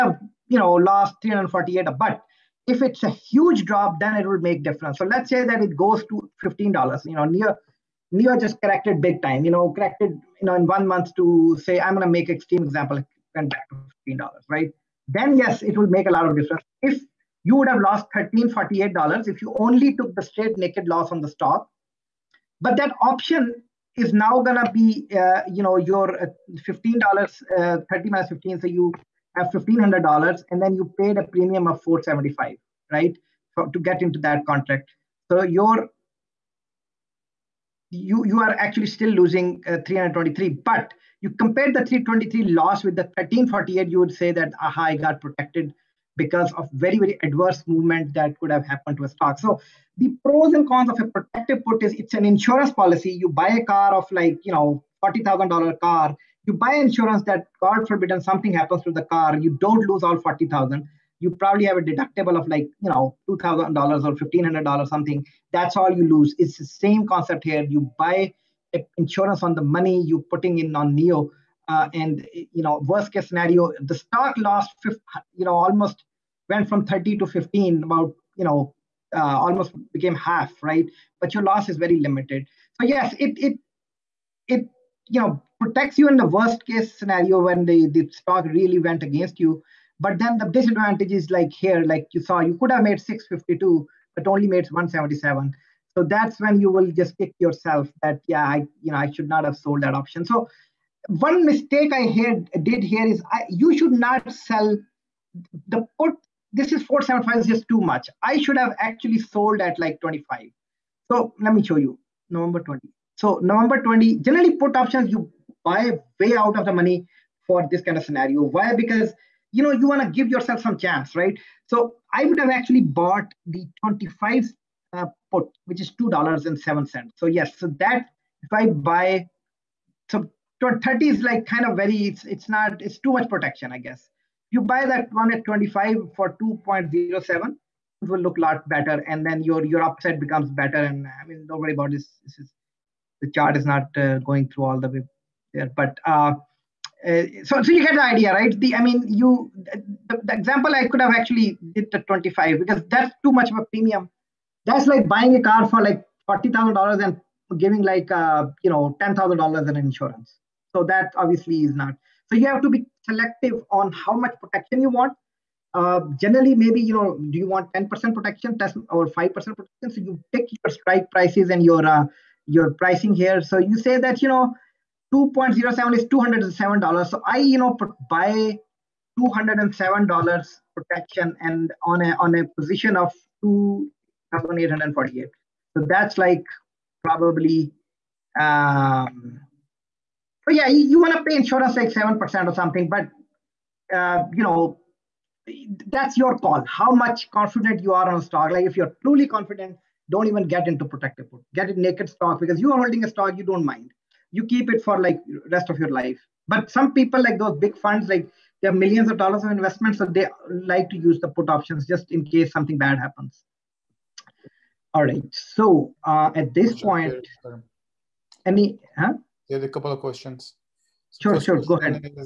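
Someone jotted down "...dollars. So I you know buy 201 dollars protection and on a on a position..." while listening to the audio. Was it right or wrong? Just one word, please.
wrong.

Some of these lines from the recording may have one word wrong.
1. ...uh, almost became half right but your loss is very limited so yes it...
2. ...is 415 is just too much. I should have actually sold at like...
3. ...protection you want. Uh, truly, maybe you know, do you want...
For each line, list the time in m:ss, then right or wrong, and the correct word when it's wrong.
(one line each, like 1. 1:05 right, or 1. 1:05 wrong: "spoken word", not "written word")
1. 1:19 right
2. 1:46 wrong: "475", not "415"
3. 2:44 wrong: "generally", not "truly".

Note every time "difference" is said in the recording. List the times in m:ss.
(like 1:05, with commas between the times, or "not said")
0:04, 0:16.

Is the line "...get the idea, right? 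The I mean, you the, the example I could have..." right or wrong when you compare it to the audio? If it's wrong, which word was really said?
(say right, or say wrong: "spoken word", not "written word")
right.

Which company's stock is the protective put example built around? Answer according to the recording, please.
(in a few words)
NIO.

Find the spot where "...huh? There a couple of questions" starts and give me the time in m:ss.
3:38.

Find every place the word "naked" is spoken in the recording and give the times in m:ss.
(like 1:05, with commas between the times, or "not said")
0:20, 3:21.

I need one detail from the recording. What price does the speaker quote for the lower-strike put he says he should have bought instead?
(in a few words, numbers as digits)
$2.07.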